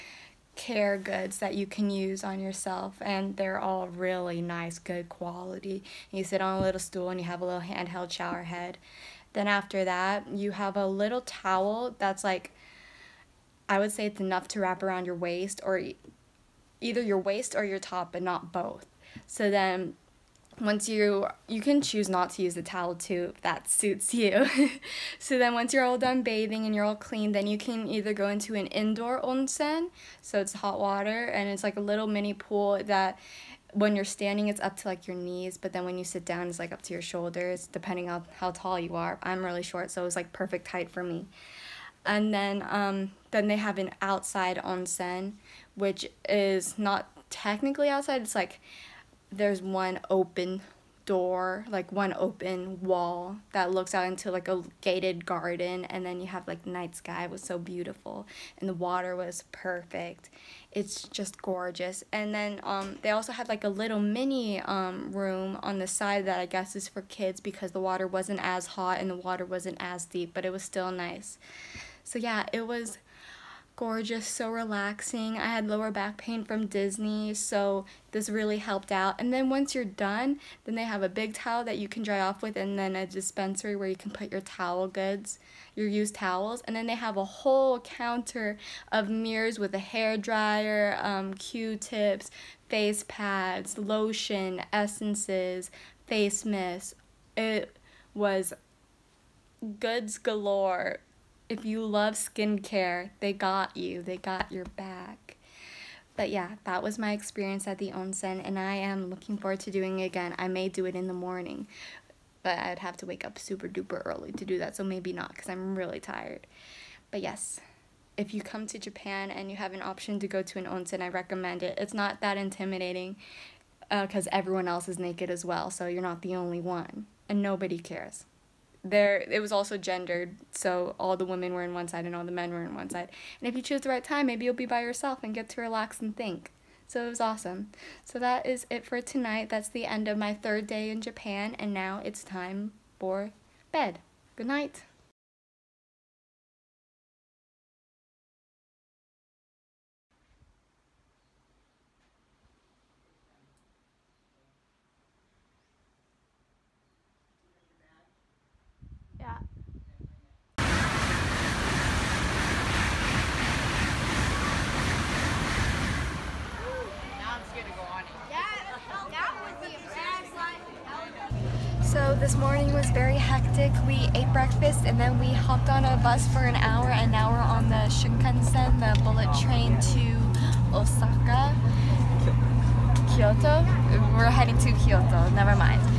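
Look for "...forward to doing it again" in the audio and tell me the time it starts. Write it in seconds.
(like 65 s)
109 s.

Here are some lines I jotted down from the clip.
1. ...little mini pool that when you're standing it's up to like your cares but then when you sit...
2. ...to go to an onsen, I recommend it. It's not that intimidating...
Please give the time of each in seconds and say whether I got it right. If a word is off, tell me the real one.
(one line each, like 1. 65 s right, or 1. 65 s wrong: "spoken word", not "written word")
1. 31 s wrong: "knees", not "cares"
2. 120 s right.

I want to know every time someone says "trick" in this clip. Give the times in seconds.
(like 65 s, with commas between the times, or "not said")
not said.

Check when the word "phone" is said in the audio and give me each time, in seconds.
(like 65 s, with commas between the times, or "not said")
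not said.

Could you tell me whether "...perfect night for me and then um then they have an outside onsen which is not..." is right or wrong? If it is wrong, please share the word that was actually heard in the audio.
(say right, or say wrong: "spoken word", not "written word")
wrong: "height", not "night".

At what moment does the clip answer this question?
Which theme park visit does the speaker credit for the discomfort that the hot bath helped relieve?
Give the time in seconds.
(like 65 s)
76 s.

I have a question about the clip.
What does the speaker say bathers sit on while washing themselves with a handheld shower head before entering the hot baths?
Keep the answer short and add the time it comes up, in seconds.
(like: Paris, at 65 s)
A little stool, at 6 s.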